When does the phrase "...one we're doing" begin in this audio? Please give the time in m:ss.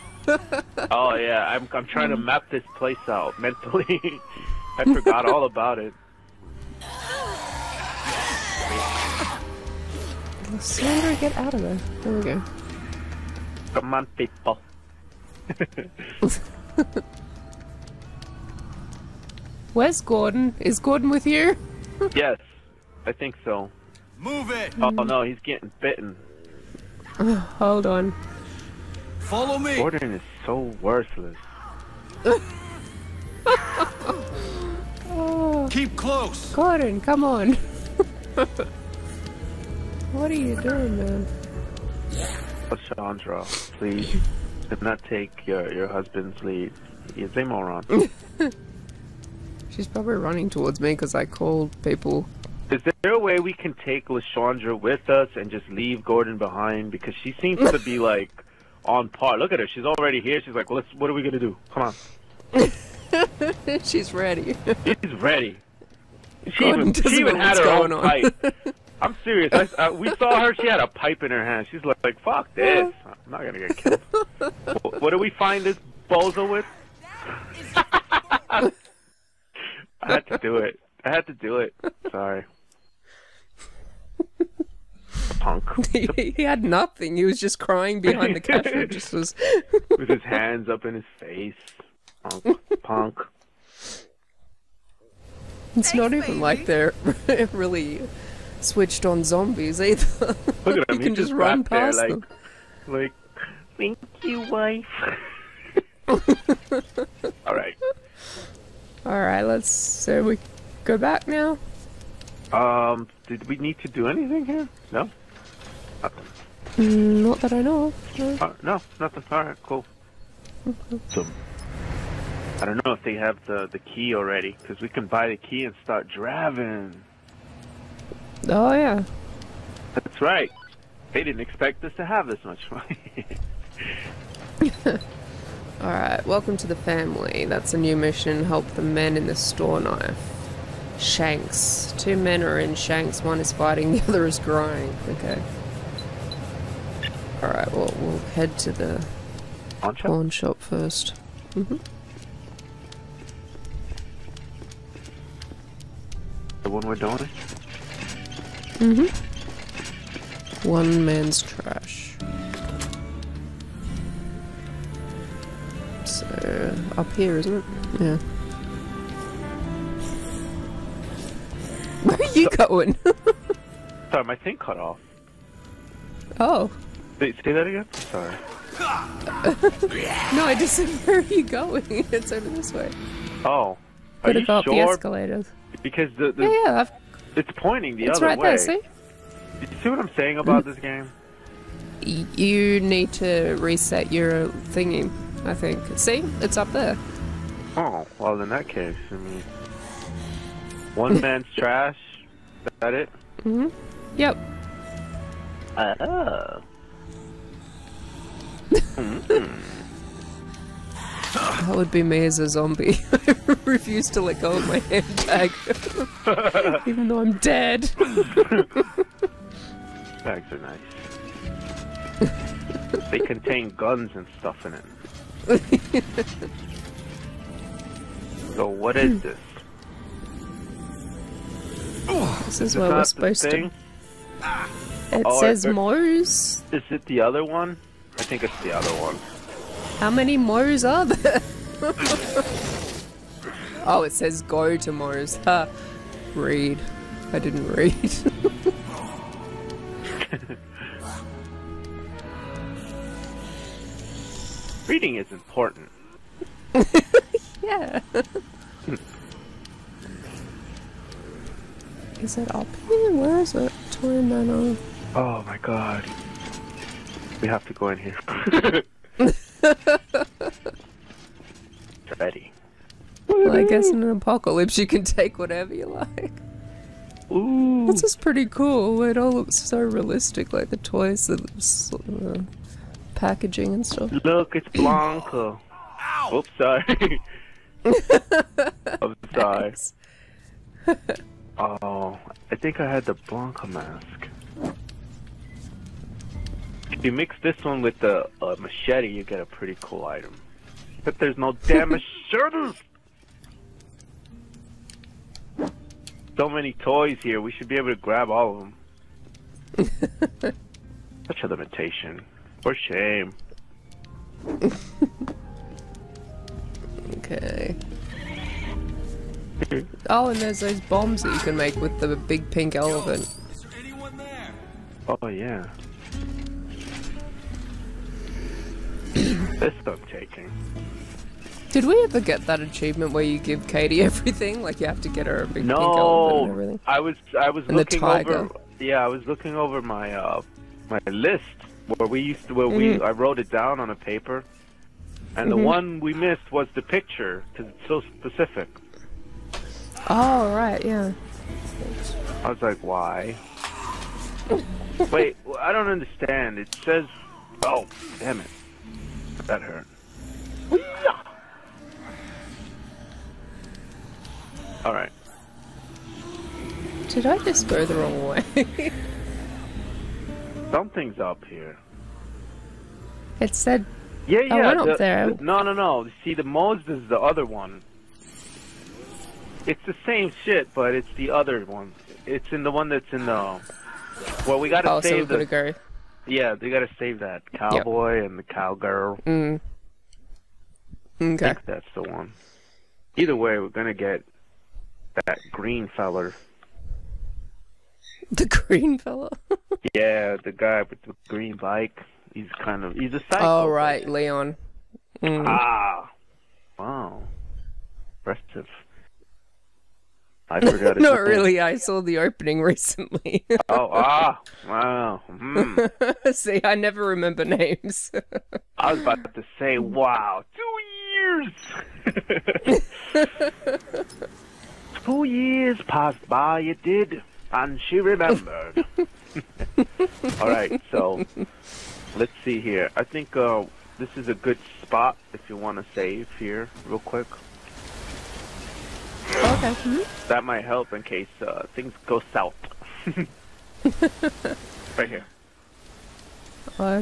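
2:36.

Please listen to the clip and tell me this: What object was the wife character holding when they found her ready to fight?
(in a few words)
a pipe.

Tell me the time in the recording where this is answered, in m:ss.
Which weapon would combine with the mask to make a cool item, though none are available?
4:58.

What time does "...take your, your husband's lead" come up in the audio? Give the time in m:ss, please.
0:45.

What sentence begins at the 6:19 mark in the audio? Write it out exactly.
It's the same shit, but it's the other one.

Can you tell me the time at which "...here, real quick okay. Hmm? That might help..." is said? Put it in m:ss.
7:16.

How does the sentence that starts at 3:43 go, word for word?
they contain guns and stuff in it.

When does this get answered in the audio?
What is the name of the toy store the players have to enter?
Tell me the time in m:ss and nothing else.
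4:23.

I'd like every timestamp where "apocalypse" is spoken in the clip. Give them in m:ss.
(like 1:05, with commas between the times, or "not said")
4:34.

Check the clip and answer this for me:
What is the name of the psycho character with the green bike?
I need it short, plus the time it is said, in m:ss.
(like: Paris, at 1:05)
Leon, at 6:44.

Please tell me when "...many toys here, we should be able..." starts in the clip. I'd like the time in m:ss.
5:06.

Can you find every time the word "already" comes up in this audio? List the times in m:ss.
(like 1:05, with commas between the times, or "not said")
0:59, 2:04.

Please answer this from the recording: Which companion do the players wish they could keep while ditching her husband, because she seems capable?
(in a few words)
Lashandra.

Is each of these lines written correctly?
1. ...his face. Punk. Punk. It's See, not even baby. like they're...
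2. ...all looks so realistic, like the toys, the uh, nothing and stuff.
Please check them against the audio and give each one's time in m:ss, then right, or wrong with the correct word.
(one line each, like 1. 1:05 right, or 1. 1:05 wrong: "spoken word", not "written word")
1. 1:30 wrong: "Thanks", not "See"
2. 4:39 wrong: "packaging", not "nothing".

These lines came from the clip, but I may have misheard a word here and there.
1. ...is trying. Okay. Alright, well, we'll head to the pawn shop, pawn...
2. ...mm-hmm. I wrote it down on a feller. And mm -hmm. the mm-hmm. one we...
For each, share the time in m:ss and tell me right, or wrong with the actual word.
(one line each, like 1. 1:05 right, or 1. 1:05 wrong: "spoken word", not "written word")
1. 2:24 wrong: "crying", not "trying"
2. 5:42 wrong: "paper", not "feller".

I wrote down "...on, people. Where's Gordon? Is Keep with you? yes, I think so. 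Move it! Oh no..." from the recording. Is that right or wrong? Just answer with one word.
wrong.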